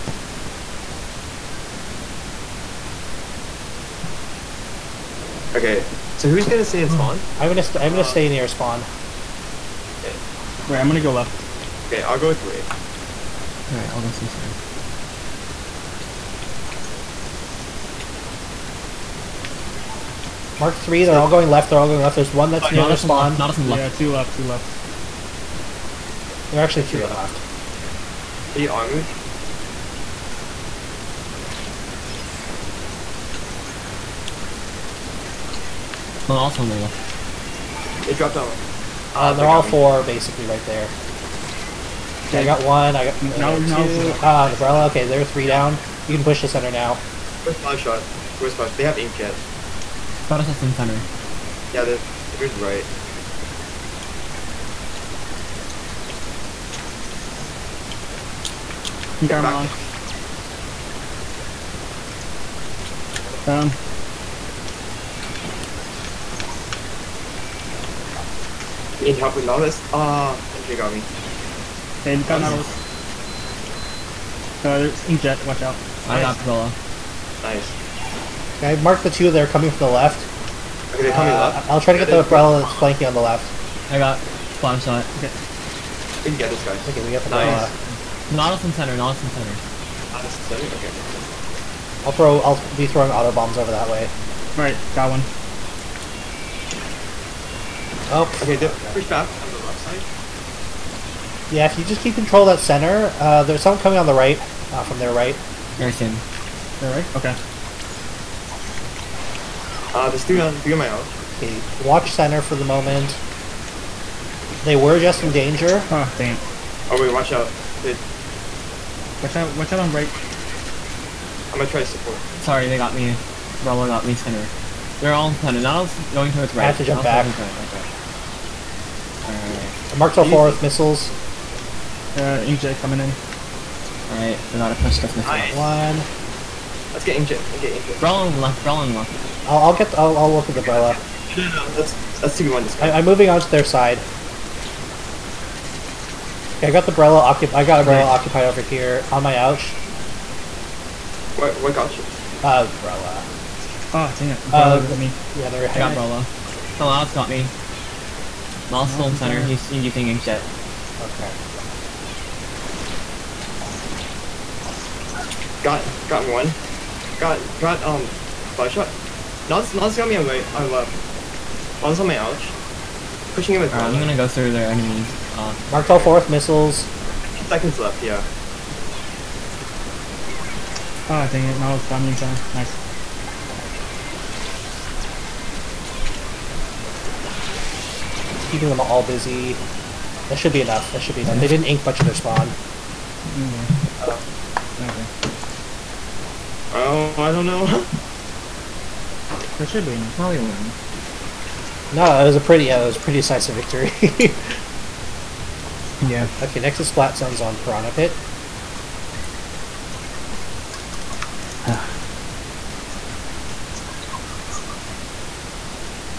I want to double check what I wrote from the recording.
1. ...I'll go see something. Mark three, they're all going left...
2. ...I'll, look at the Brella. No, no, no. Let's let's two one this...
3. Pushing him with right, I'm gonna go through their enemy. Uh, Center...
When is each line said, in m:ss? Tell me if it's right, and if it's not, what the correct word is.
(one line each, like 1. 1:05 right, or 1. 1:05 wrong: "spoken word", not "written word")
1. 0:13 right
2. 2:20 right
3. 2:53 wrong: "Mark", not "Center".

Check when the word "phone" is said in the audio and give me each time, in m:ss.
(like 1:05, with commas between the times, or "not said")
not said.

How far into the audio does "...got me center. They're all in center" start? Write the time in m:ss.
2:03.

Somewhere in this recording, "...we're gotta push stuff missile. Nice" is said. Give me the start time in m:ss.
2:14.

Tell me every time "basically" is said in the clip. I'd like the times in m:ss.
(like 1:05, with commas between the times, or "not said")
0:40.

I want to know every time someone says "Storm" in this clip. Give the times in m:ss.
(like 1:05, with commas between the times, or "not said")
2:38.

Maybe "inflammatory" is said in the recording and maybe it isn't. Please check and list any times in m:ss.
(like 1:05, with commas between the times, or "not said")
not said.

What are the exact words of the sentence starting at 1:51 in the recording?
Okay, watch center for the moment.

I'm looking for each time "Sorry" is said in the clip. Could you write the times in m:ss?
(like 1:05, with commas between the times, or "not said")
2:02.